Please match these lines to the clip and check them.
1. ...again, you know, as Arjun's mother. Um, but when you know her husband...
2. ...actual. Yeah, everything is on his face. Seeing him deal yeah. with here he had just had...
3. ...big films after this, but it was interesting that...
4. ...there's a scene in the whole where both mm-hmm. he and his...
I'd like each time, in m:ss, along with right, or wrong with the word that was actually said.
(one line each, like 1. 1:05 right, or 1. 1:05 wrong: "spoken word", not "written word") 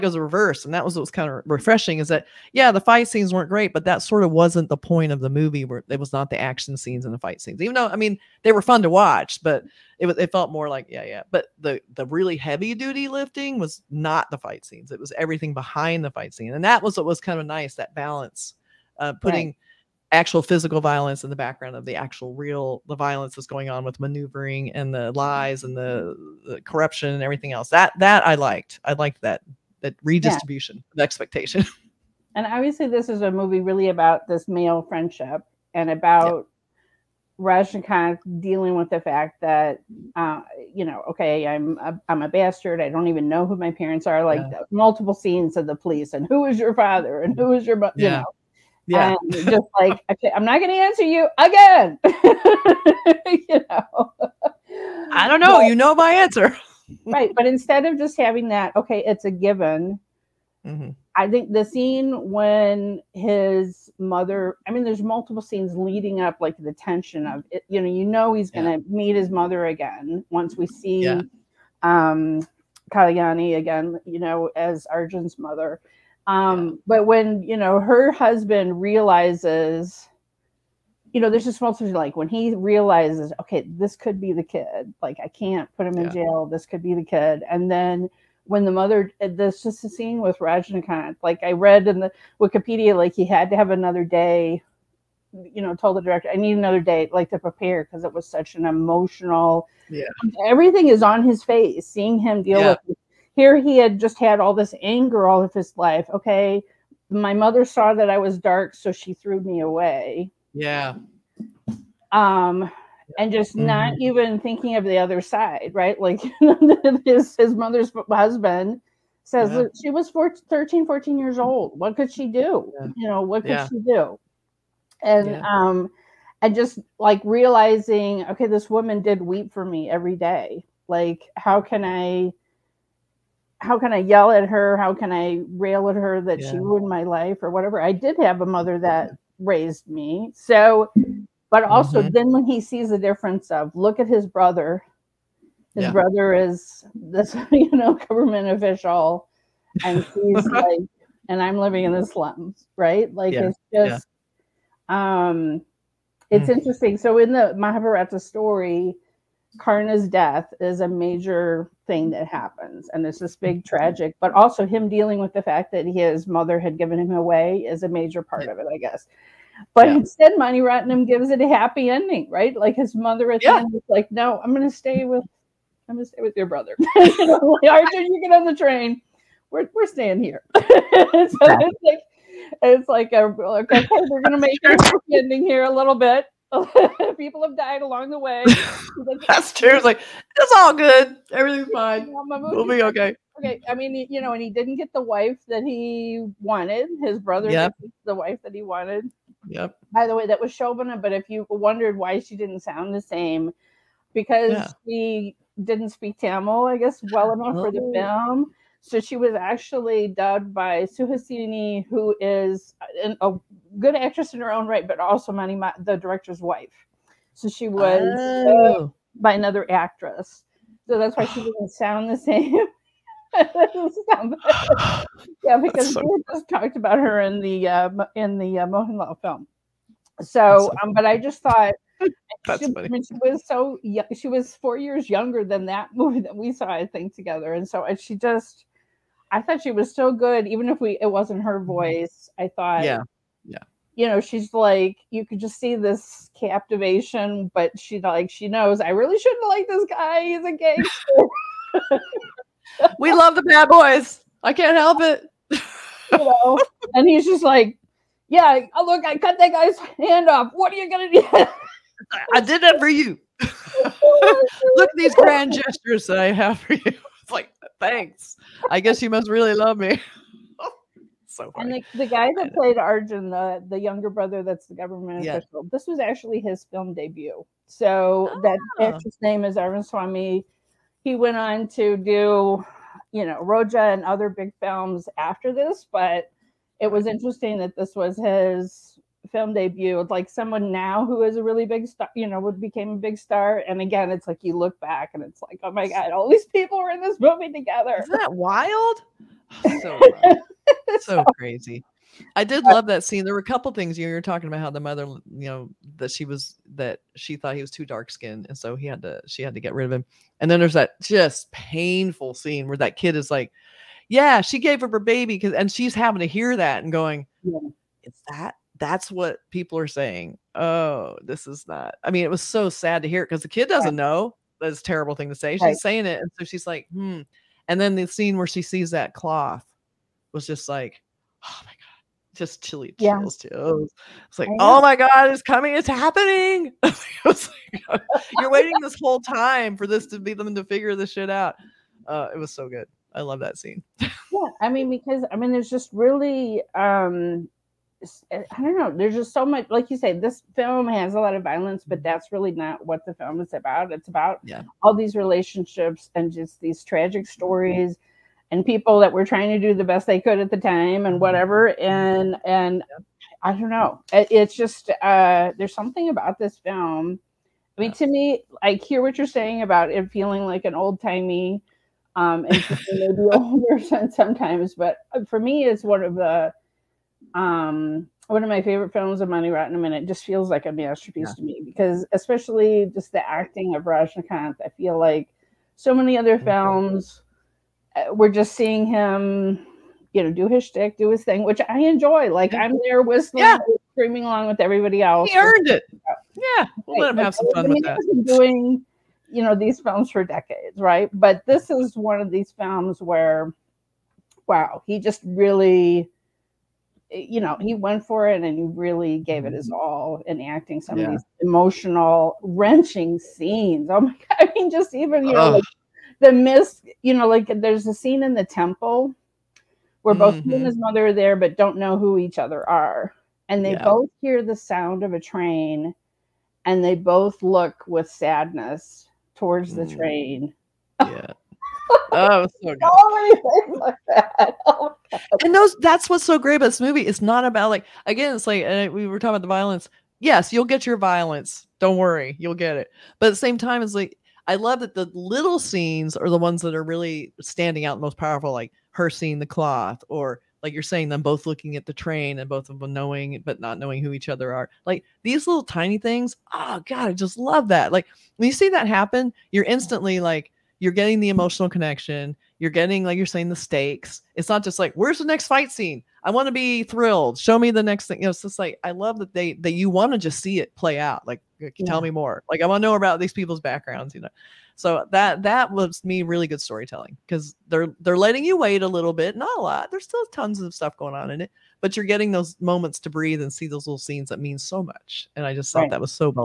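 1. 1:13 right
2. 1:38 wrong: "emotional", not "actual"
3. 4:44 right
4. 6:57 wrong: "temple", not "whole".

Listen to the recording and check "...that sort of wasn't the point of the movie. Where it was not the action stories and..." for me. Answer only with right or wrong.
wrong.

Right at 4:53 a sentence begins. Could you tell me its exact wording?
And again, it's like you look back and it's like, oh my god, all these people were in this movie together.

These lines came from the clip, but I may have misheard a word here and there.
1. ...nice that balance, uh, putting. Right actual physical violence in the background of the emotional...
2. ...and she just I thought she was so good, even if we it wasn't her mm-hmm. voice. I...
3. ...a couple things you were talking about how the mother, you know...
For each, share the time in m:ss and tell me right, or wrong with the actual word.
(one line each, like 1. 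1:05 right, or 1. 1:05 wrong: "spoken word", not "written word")
1. 0:17 wrong: "actual", not "emotional"
2. 3:57 right
3. 5:03 right.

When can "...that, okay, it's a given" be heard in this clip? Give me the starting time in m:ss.
0:58.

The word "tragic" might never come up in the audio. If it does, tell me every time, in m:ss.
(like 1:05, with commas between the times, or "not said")
2:43, 5:56.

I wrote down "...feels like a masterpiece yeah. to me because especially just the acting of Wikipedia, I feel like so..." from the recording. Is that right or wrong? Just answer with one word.
wrong.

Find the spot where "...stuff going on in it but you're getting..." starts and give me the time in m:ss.
8:00.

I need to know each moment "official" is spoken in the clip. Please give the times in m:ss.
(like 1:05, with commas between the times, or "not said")
2:28, 4:35.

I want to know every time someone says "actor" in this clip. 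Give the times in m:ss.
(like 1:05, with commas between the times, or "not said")
4:38.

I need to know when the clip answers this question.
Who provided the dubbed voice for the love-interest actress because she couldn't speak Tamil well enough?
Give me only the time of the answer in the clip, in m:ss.
3:30.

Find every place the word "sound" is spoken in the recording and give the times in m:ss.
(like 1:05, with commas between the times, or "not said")
3:22, 3:41, 7:04.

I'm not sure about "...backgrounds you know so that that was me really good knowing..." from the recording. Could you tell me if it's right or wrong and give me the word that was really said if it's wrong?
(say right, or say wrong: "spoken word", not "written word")
wrong: "storytelling", not "knowing".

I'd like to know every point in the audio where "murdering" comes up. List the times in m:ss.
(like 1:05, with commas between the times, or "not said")
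not said.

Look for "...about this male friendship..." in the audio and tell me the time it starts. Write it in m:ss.
0:33.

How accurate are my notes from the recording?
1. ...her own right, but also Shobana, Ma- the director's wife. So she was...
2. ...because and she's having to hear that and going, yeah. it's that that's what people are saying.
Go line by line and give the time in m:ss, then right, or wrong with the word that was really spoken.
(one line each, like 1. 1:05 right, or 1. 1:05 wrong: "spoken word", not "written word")
1. 3:34 wrong: "Mani", not "Shobana"
2. 5:15 right.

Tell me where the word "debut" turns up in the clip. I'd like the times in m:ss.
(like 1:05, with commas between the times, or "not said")
4:36, 4:49.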